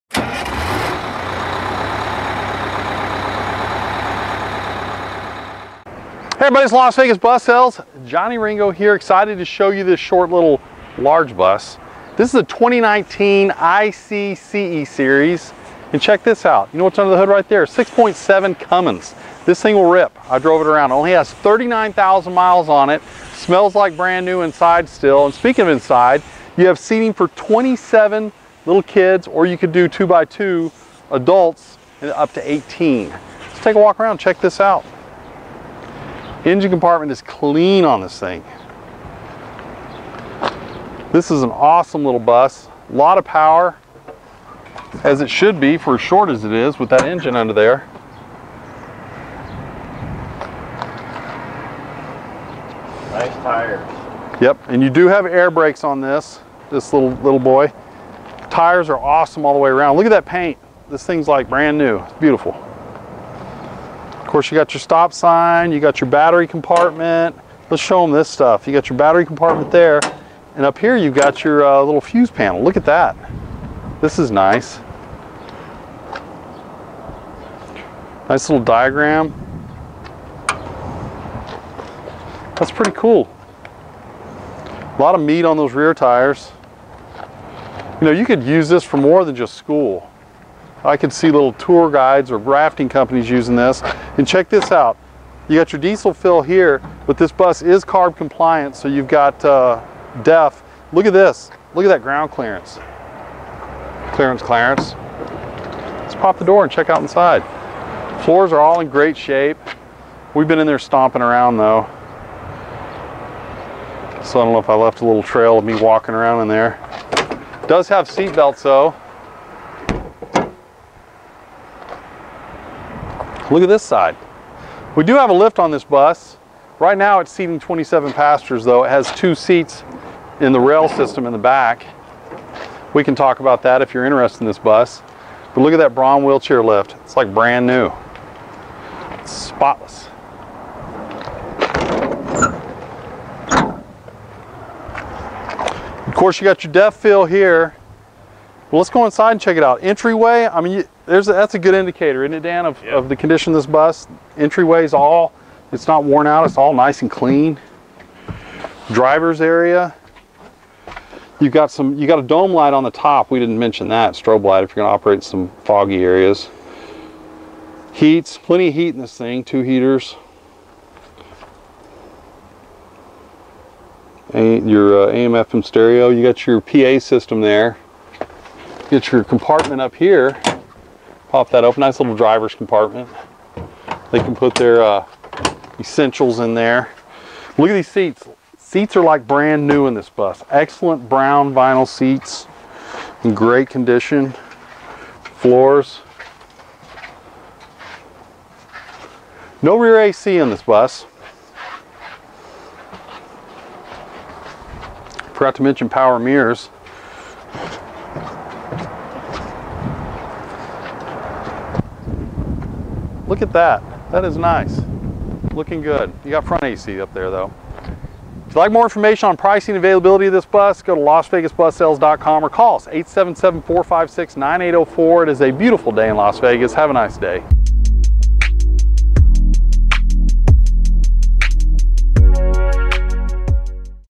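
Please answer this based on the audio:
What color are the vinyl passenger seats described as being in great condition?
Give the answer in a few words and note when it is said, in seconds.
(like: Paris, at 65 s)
Brown, at 191 s.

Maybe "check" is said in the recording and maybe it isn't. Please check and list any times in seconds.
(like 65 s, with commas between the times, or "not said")
16 s, 34 s, 94 s, 106 s, 149 s.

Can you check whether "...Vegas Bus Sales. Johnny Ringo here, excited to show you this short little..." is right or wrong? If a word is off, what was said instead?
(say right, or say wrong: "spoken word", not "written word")
right.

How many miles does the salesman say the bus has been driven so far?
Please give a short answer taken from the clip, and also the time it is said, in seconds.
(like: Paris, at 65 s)
39,000, at 21 s.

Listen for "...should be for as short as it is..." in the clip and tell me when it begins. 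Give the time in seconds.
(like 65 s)
45 s.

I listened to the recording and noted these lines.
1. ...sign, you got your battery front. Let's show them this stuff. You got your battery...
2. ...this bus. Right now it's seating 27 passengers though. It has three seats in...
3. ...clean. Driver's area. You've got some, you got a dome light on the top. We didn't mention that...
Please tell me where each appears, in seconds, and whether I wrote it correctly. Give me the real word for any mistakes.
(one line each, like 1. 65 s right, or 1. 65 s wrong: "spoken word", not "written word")
1. 65 s wrong: "compartment", not "front"
2. 125 s wrong: "two", not "three"
3. 157 s right.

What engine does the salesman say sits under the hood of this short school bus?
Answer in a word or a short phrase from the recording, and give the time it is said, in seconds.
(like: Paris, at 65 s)
6.7 Cummins, at 17 s.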